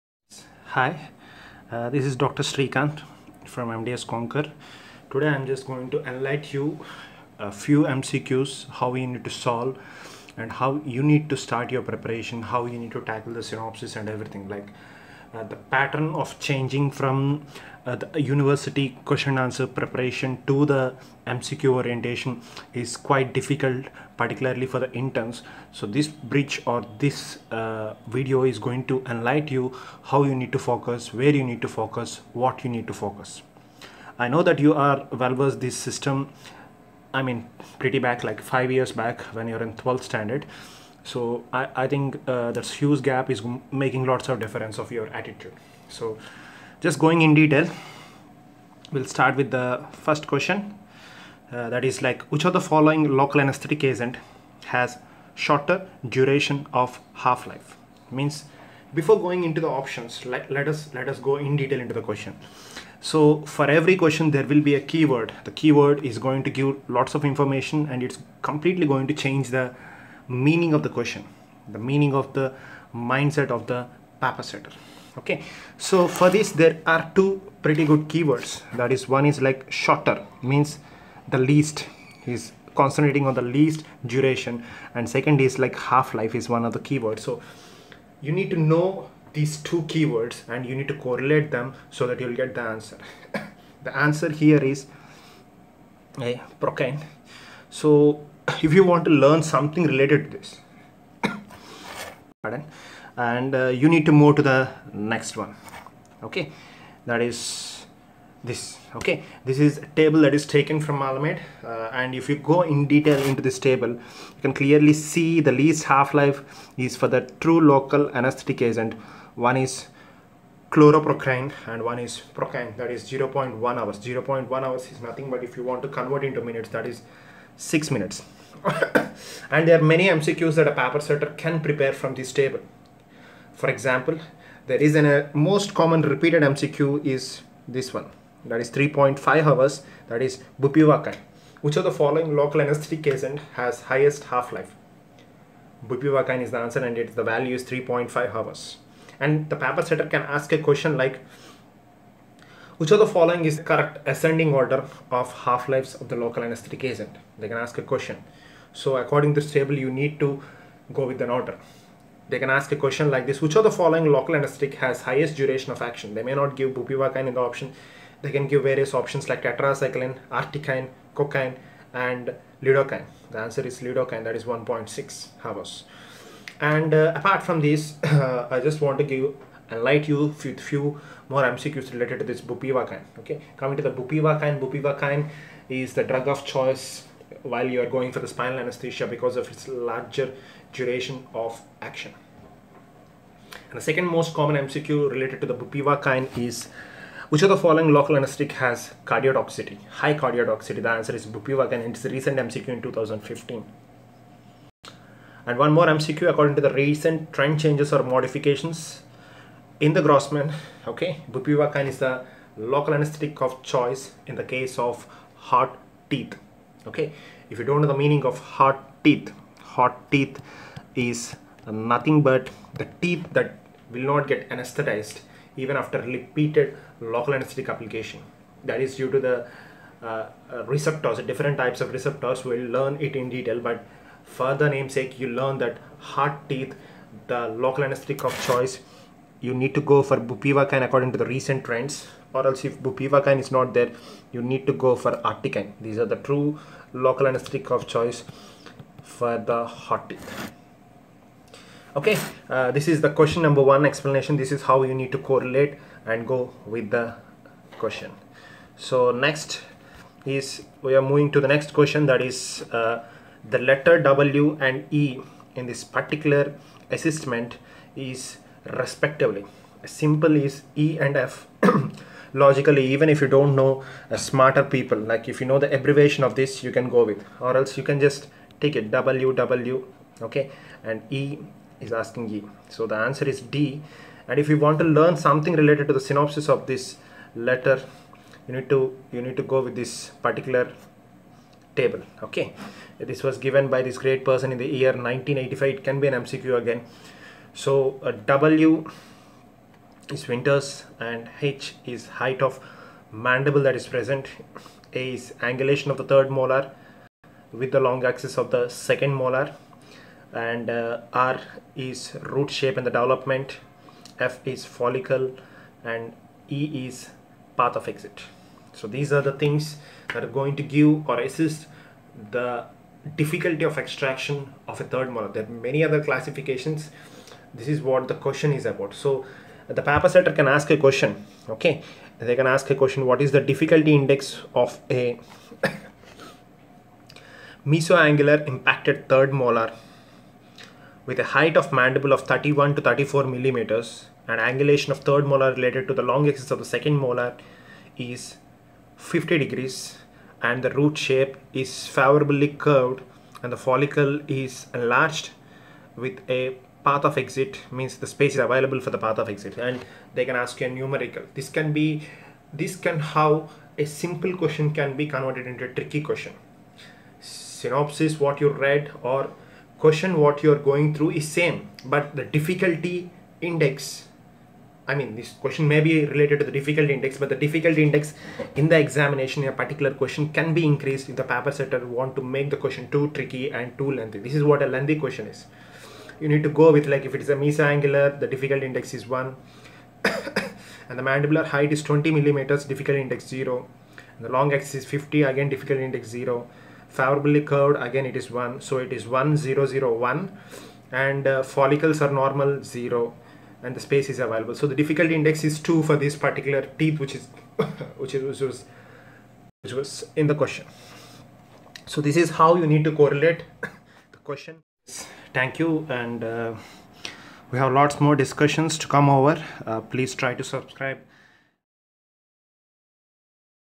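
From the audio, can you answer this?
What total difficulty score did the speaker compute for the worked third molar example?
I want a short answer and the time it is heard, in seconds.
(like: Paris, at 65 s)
2, at 405 s.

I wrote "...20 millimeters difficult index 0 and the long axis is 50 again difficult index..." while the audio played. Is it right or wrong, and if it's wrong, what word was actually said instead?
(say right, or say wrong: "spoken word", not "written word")
right.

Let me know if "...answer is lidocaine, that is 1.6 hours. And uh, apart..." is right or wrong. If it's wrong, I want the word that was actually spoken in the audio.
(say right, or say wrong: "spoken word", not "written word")
right.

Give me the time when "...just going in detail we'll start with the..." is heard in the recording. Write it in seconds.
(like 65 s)
46 s.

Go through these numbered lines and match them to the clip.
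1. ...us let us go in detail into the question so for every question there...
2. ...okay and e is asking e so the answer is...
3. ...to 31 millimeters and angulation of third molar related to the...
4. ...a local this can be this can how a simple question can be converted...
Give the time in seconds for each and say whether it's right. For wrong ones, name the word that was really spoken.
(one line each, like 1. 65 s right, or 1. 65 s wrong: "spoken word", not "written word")
1. 60 s right
2. 280 s right
3. 342 s wrong: "34", not "31"
4. 360 s wrong: "numerical", not "local".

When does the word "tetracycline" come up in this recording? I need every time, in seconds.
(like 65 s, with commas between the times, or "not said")
169 s.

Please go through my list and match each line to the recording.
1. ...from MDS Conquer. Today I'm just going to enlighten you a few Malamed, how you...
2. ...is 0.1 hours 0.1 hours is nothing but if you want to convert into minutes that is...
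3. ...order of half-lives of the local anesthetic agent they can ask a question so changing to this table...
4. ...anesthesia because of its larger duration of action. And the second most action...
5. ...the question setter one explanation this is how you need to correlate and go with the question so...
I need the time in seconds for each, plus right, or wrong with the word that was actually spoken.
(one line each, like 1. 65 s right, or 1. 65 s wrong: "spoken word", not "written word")
1. 3 s wrong: "MCQs", not "Malamed"
2. 122 s right
3. 154 s wrong: "according", not "changing"
4. 188 s wrong: "common", not "action"
5. 253 s wrong: "number", not "setter".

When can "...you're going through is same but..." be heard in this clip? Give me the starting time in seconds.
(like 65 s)
370 s.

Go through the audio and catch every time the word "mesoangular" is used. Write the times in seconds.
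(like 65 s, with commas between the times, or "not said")
337 s, 387 s.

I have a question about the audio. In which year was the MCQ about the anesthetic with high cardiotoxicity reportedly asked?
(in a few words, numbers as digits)
2015.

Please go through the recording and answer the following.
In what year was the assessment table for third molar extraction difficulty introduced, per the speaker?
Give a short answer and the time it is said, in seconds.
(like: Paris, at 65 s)
1985, at 294 s.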